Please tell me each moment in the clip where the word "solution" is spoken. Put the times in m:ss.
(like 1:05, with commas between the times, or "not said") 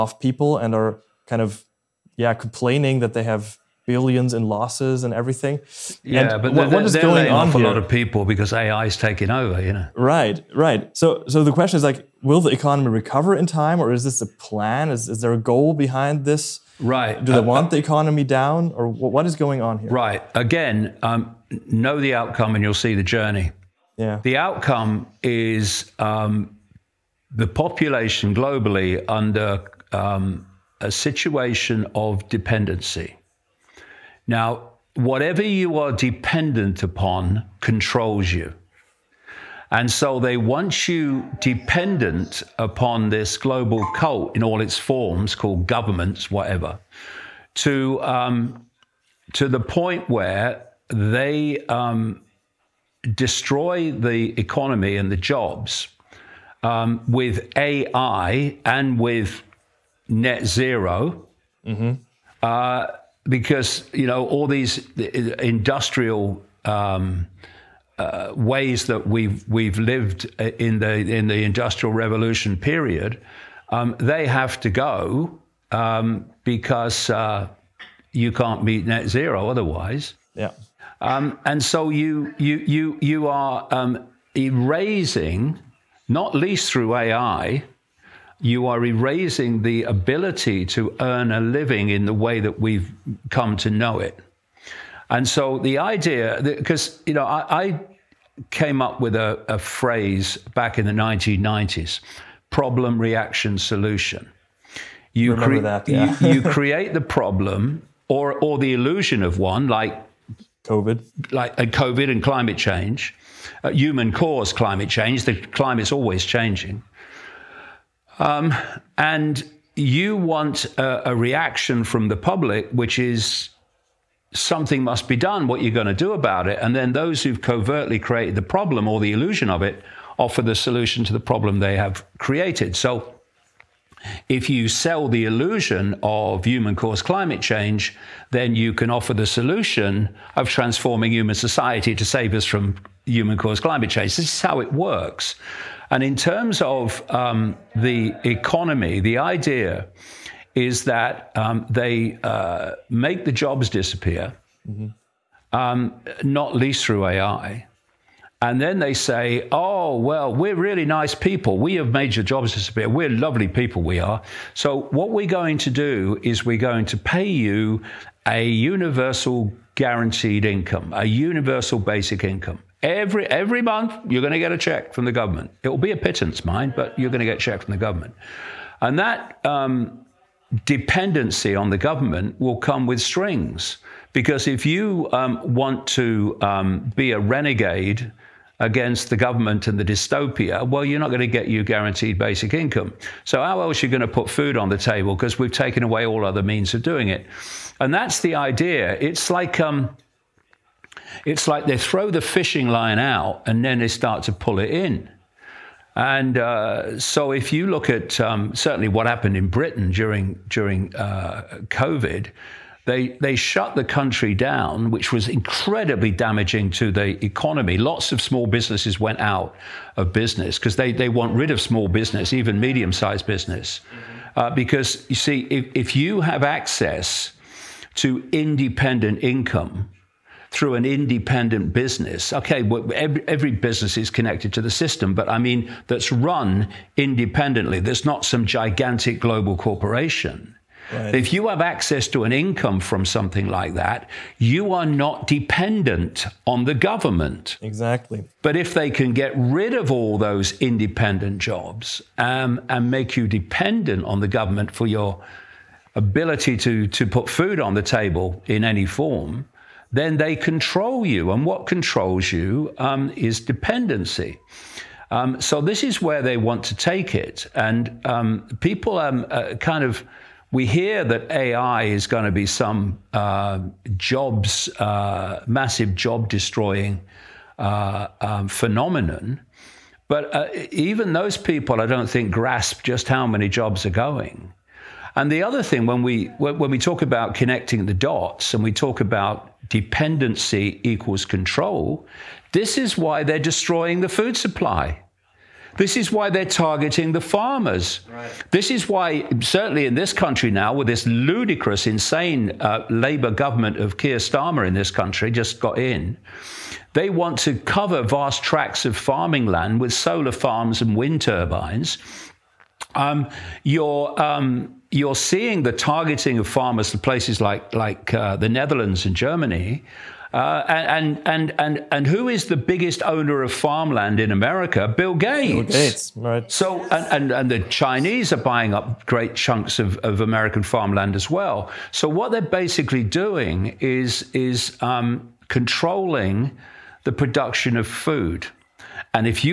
1:43, 2:10, 2:19.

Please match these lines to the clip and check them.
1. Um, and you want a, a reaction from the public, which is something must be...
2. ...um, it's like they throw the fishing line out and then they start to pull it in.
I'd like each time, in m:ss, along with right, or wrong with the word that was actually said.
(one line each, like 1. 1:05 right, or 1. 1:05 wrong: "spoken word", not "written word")
1. 1:58 right
2. 3:19 right.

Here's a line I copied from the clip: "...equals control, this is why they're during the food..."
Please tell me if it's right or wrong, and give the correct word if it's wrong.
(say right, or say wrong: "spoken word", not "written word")
wrong: "destroying", not "during".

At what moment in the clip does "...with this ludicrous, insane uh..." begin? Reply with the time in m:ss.
5:00.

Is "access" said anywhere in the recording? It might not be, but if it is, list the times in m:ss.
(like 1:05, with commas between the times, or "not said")
3:46, 4:01.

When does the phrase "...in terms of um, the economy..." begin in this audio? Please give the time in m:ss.
2:26.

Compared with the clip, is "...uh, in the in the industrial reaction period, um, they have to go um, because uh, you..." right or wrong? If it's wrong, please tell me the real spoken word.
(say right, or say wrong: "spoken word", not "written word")
wrong: "revolution", not "reaction".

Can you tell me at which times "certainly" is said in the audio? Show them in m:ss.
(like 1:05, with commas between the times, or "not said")
3:28, 4:59.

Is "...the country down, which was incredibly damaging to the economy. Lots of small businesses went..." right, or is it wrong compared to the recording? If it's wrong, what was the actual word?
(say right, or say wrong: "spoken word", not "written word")
right.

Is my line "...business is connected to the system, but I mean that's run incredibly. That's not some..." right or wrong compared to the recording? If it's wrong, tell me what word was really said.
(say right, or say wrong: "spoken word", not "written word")
wrong: "independently", not "incredibly".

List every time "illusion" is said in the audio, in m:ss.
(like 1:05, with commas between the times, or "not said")
1:48, 2:09, 2:15.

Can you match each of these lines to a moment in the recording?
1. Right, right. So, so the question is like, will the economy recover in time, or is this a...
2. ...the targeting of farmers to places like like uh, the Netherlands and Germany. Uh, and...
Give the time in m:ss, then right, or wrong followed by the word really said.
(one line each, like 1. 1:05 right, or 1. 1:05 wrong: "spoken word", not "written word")
1. 0:09 right
2. 5:15 right.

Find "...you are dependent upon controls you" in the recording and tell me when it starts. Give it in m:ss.
0:35.